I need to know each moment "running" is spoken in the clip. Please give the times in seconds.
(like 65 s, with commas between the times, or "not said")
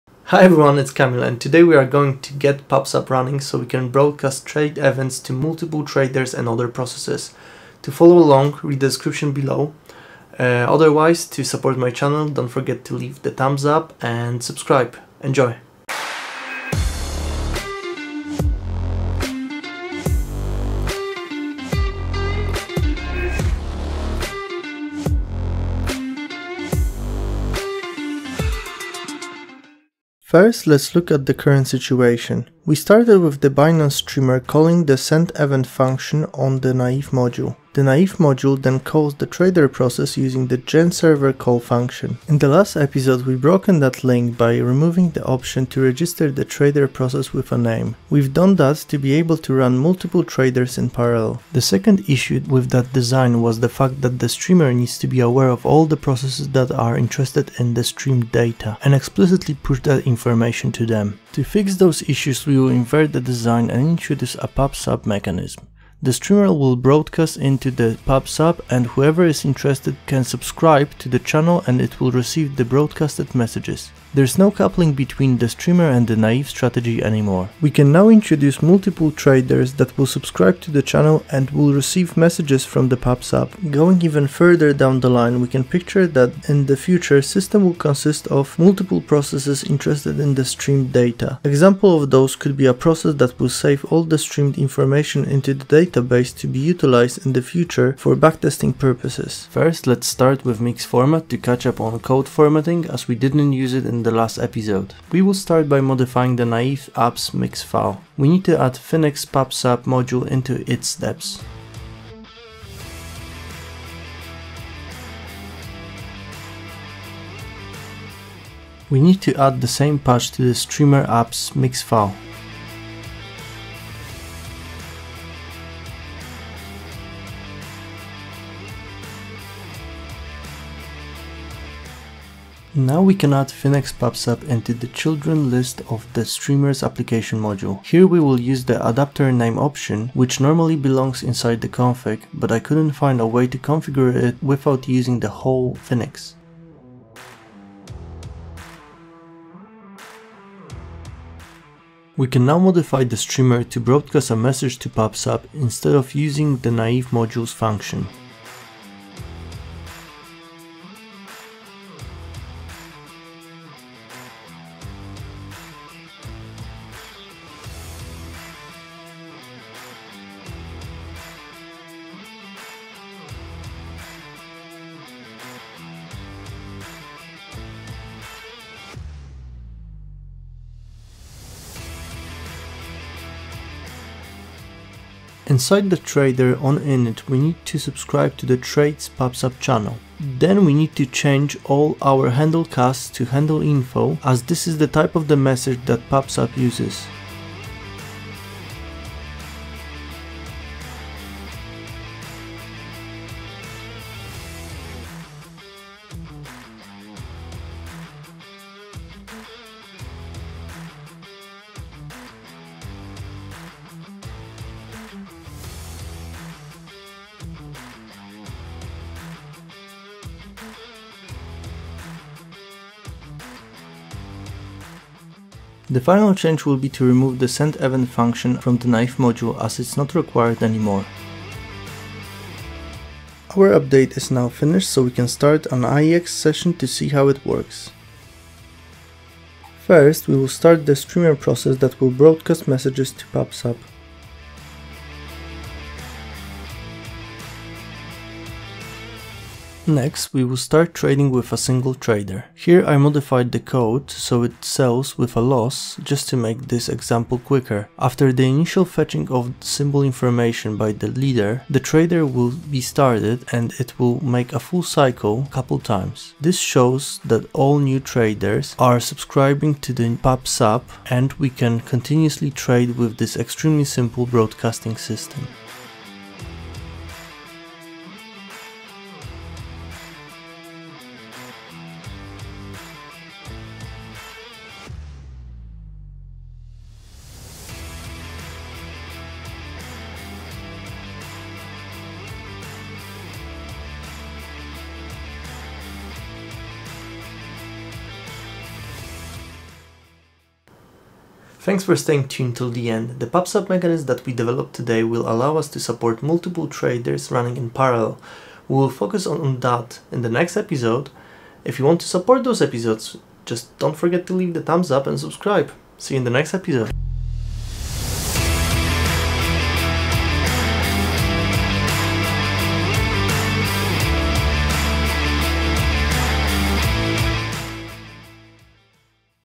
3 s, 307 s.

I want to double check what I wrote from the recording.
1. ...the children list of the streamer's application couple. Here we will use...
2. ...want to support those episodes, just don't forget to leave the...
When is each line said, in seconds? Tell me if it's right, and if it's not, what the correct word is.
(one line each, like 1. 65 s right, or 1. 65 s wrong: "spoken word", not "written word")
1. 134 s wrong: "module", not "couple"
2. 311 s right.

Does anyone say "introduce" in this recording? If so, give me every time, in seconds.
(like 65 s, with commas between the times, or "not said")
63 s, 78 s.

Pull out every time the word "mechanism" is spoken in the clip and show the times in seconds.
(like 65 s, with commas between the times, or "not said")
65 s, 303 s.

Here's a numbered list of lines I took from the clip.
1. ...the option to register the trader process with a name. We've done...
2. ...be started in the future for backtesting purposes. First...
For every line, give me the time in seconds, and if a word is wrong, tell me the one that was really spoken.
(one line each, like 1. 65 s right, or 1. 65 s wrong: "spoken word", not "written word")
1. 45 s right
2. 96 s wrong: "utilized", not "started".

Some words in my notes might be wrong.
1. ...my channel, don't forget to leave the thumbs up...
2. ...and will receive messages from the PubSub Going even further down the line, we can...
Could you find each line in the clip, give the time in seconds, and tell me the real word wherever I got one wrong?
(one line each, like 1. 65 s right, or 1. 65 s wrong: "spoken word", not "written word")
1. 11 s right
2. 81 s right.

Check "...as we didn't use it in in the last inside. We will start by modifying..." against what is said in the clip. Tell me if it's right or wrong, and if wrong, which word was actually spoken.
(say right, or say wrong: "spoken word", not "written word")
wrong: "episode", not "inside".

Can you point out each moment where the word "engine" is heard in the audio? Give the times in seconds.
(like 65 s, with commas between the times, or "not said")
not said.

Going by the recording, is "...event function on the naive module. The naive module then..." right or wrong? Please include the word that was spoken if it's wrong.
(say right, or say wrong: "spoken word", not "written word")
right.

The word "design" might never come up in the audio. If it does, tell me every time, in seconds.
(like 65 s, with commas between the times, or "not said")
52 s, 63 s.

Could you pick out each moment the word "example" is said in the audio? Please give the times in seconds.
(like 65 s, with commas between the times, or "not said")
91 s, 256 s.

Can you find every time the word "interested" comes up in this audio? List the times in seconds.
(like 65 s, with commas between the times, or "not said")
56 s, 69 s, 89 s.